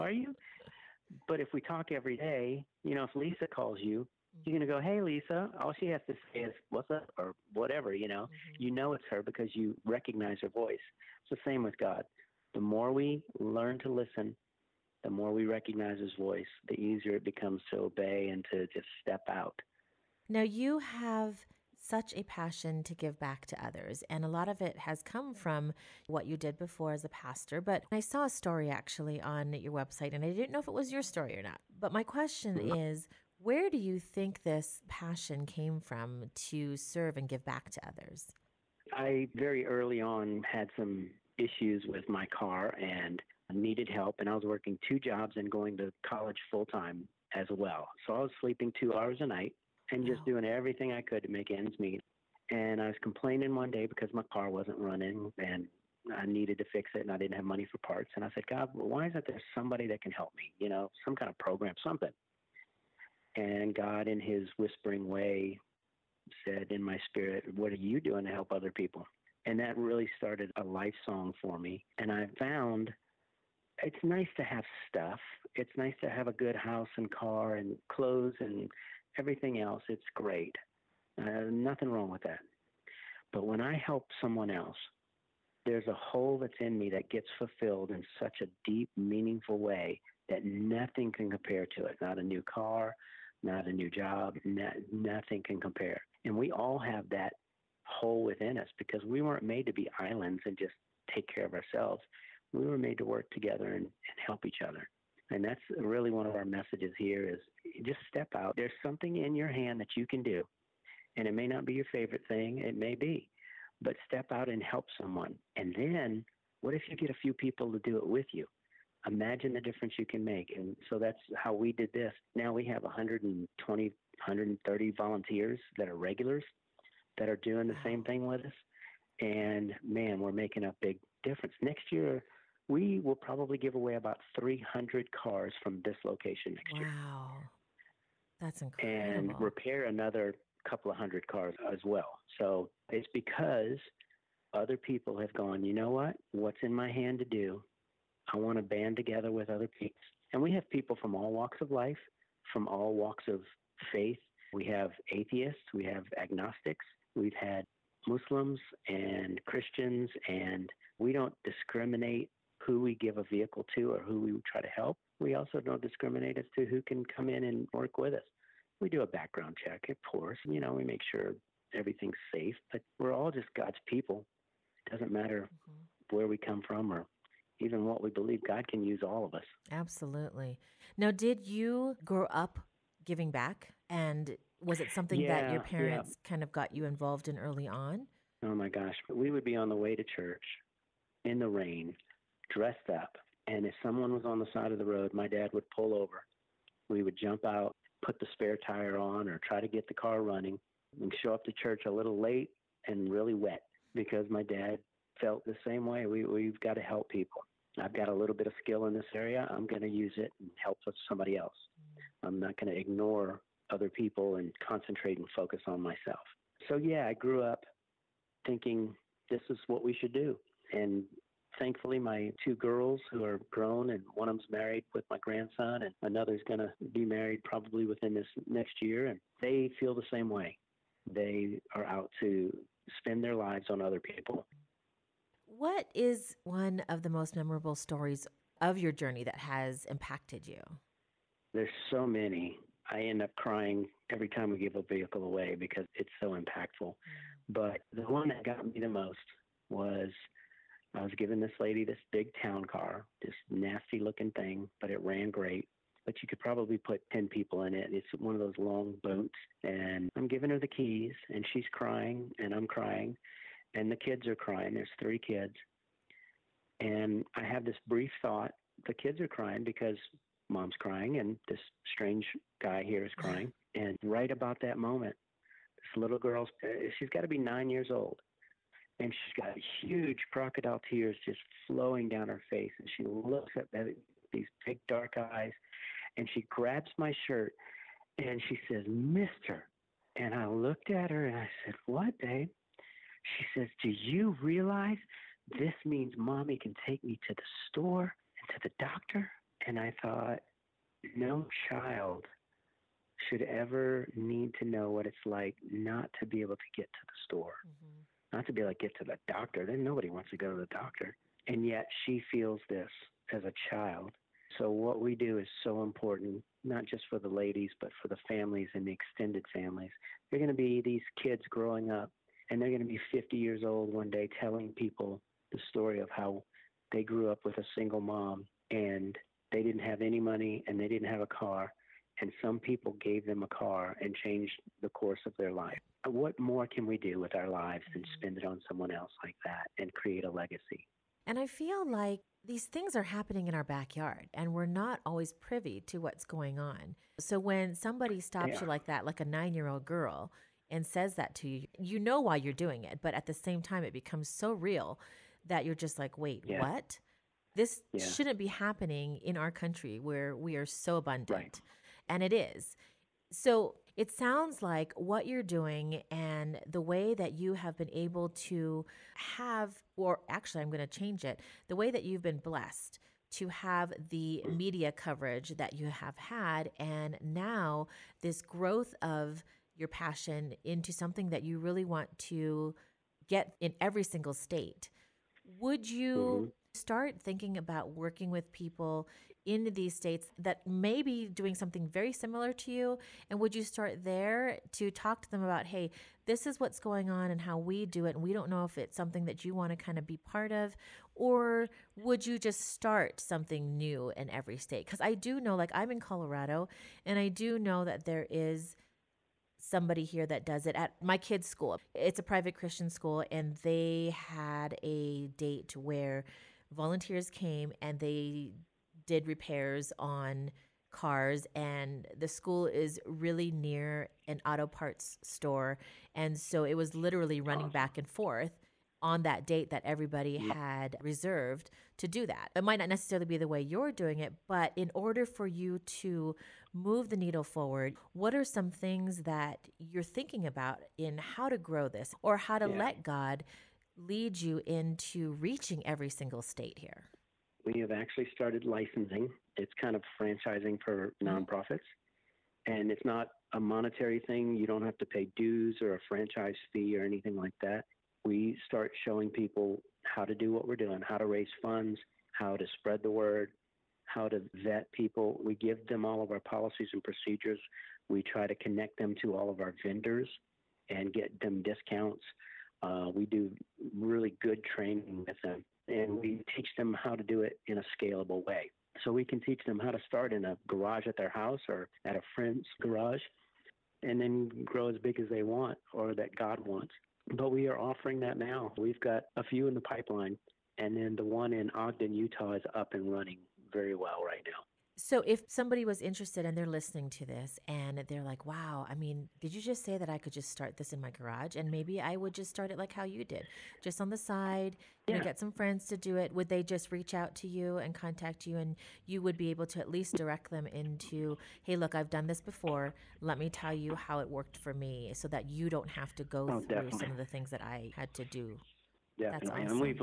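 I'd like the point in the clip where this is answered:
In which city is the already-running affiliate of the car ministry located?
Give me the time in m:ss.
8:11.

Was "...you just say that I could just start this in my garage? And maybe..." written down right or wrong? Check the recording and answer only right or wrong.
right.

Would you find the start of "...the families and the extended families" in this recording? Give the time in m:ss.
5:18.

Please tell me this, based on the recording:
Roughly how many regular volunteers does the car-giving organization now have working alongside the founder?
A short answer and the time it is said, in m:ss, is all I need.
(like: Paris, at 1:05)
120 to 130, at 2:02.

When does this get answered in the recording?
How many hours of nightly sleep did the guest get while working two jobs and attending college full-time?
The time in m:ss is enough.
0:48.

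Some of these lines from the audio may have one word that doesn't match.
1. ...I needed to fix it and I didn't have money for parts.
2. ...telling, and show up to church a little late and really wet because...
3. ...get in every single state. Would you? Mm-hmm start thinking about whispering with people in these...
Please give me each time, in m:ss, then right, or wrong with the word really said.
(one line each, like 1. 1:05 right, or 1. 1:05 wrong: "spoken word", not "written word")
1. 0:56 right
2. 3:20 wrong: "running", not "telling"
3. 6:23 wrong: "working", not "whispering".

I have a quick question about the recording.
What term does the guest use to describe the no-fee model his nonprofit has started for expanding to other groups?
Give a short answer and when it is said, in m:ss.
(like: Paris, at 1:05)
Licensing, at 7:28.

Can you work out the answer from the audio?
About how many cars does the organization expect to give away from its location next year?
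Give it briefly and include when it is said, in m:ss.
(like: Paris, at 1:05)
300, at 2:13.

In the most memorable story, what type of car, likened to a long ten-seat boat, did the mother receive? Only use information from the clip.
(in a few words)
Town car.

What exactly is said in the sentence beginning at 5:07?
Mm-hmm not to be like get to the doctor.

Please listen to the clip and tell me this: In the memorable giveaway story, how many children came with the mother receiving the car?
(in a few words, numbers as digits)
3.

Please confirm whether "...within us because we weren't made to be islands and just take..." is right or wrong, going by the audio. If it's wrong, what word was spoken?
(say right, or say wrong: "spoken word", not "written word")
right.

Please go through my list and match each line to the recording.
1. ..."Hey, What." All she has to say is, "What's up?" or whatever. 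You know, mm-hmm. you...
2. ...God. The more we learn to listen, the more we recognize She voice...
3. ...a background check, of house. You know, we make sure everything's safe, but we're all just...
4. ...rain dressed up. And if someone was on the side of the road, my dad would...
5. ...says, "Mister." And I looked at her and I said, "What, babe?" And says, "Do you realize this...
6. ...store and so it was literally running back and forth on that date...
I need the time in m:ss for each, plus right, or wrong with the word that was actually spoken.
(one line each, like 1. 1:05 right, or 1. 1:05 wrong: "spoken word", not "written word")
1. 0:04 wrong: "Lisa", not "What"
2. 0:11 wrong: "His", not "She"
3. 2:49 wrong: "course", not "house"
4. 3:11 right
5. 4:48 wrong: "She", not "And"
6. 7:05 right.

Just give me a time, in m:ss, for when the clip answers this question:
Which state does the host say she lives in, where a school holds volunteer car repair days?
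6:46.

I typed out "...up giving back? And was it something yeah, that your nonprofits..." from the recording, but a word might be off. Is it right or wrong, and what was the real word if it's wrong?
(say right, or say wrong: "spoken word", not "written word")
wrong: "parents", not "nonprofits".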